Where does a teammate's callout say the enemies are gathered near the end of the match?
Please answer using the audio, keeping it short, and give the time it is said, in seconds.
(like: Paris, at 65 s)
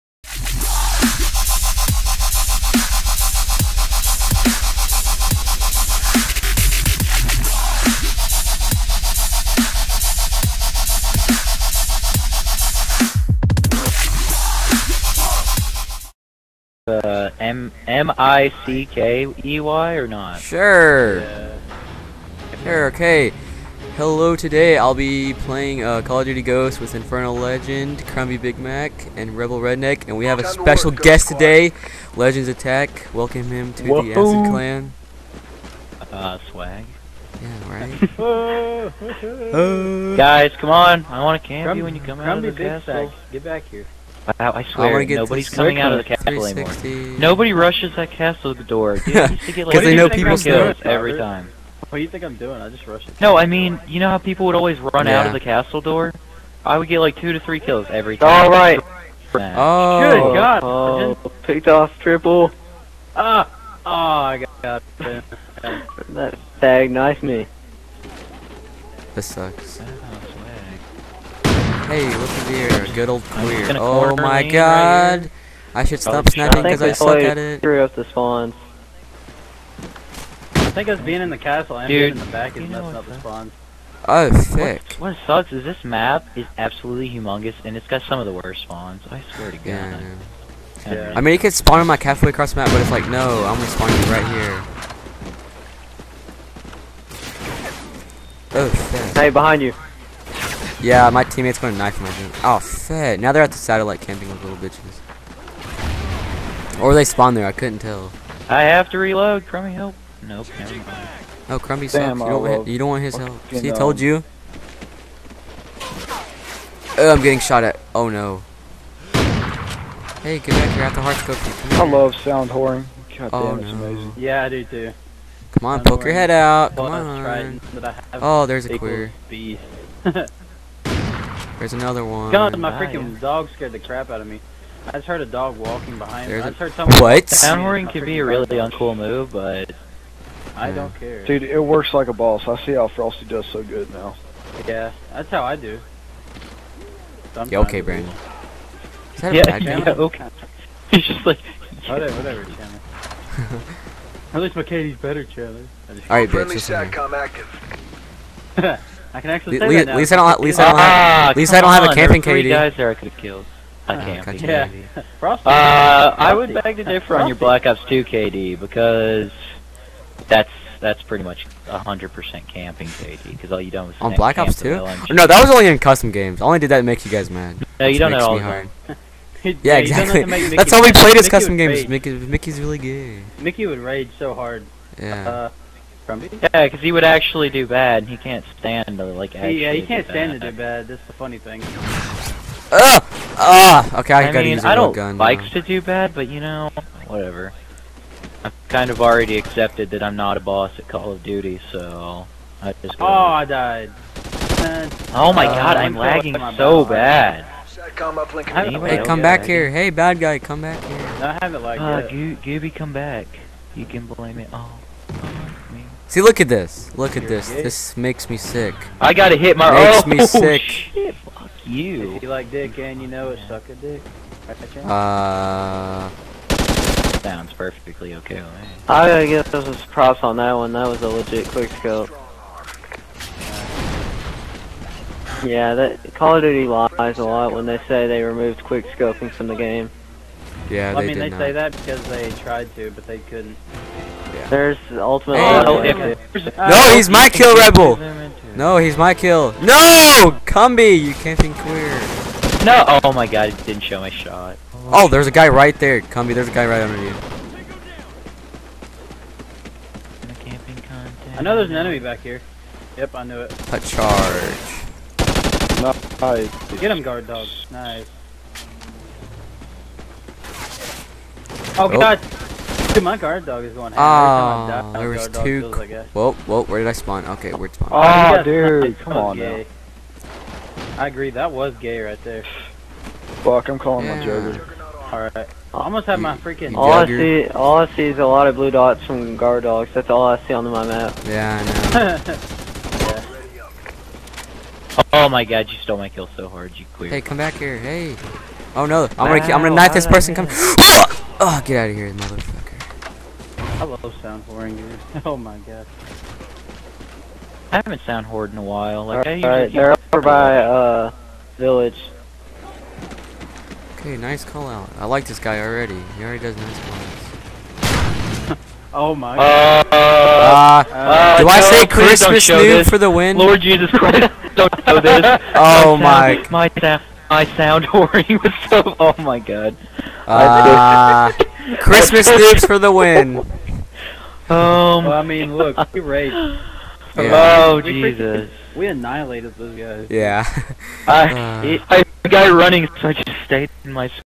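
village, at 311 s.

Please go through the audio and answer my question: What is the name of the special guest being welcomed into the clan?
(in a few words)
Legends Attack.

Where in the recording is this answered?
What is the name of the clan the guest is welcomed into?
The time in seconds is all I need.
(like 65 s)
34 s.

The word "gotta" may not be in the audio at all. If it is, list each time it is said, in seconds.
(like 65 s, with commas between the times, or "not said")
194 s, 219 s.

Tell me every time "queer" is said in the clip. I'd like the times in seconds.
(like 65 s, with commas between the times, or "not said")
73 s, 128 s, 251 s, 296 s.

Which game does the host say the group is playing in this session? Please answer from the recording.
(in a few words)
Call of Duty Ghosts.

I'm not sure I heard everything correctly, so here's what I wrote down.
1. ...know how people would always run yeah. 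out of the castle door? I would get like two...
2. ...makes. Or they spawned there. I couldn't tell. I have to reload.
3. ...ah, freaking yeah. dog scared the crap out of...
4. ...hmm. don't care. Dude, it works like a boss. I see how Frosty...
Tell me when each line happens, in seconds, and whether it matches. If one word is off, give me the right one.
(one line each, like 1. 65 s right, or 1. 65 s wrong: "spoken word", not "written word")
1. 53 s right
2. 104 s wrong: "bitches", not "makes"
3. 132 s right
4. 140 s right.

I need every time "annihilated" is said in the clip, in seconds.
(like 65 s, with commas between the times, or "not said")
338 s.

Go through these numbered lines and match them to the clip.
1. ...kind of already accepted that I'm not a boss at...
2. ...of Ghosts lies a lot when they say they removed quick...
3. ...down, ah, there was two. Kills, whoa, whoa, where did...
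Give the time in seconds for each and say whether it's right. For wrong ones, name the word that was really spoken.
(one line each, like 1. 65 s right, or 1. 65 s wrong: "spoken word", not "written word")
1. 198 s right
2. 236 s wrong: "Duty", not "Ghosts"
3. 273 s right.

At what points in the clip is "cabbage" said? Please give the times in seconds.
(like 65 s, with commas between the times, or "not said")
not said.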